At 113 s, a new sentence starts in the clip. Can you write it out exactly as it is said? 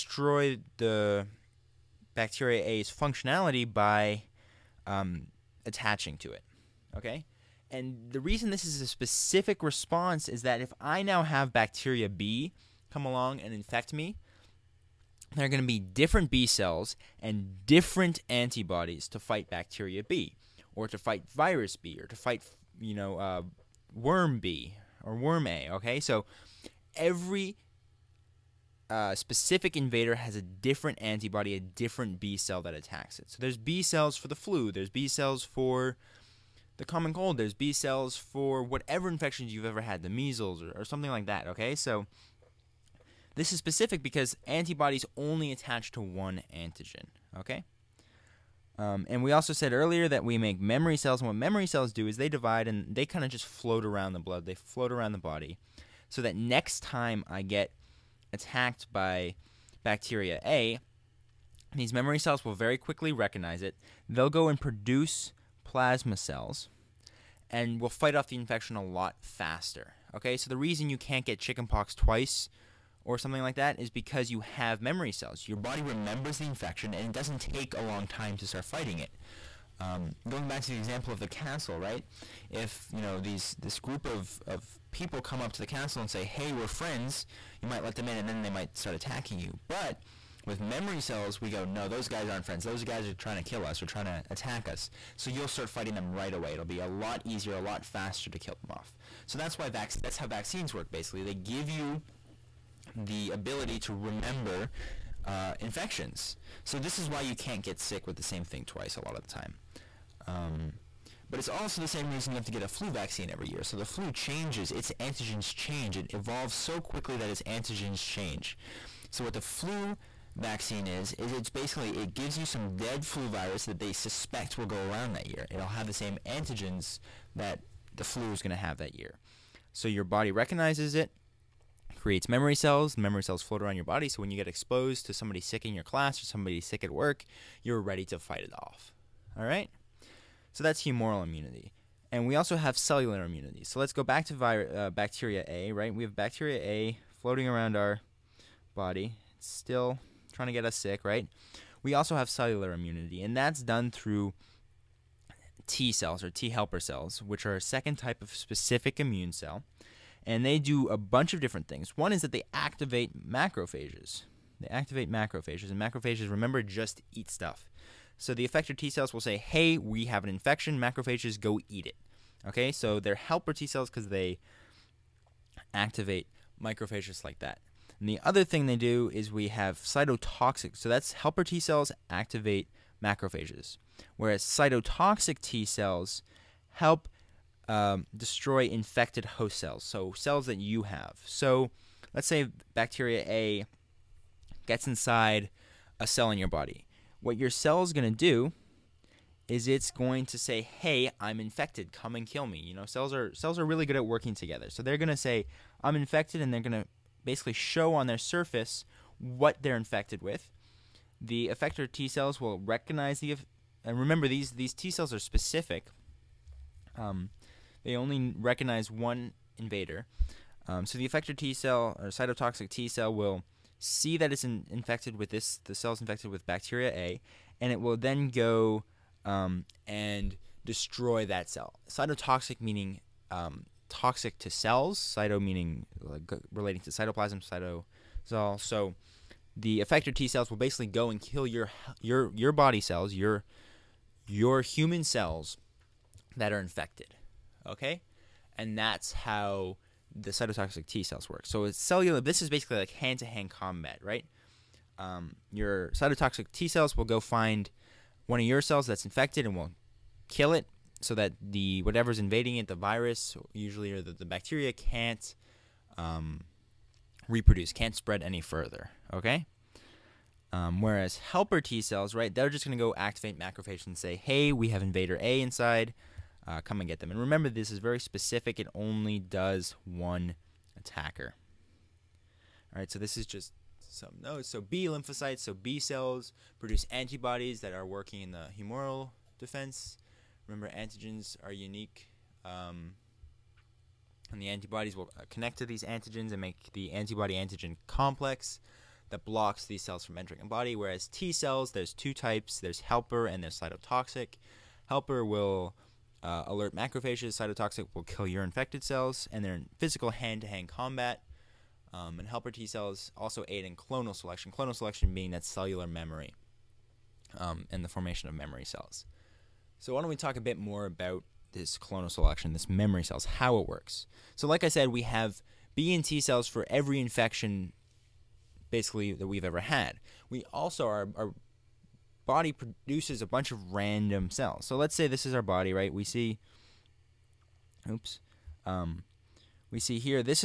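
So the flu changes, its antigens change.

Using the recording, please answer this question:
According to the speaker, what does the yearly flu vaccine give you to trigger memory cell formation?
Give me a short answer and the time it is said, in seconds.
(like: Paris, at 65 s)
dead flu virus, at 122 s.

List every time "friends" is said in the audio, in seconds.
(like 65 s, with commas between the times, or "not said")
86 s, 92 s.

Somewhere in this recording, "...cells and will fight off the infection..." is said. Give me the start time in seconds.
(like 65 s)
66 s.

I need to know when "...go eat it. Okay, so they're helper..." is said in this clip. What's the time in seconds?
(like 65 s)
171 s.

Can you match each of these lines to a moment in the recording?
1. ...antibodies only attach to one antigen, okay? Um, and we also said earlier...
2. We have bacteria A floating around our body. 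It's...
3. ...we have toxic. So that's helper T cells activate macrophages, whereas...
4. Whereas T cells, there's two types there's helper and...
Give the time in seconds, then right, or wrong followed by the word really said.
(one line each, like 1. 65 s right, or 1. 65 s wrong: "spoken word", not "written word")
1. 44 s right
2. 145 s right
3. 179 s wrong: "cytotoxic", not "toxic"
4. 300 s right.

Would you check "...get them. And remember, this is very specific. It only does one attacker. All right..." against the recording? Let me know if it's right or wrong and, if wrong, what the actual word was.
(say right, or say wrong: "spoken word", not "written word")
right.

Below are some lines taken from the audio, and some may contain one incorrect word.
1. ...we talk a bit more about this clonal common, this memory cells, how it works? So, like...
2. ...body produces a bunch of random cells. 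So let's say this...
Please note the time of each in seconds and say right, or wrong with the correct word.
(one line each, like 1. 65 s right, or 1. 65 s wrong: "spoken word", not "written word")
1. 320 s wrong: "selection", not "common"
2. 332 s right.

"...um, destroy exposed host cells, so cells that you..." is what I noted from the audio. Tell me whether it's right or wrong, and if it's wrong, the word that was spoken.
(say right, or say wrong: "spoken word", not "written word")
wrong: "infected", not "exposed".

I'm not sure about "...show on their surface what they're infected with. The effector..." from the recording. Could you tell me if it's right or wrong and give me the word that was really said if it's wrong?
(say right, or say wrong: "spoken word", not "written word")
right.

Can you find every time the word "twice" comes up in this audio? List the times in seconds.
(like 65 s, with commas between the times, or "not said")
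71 s, 108 s.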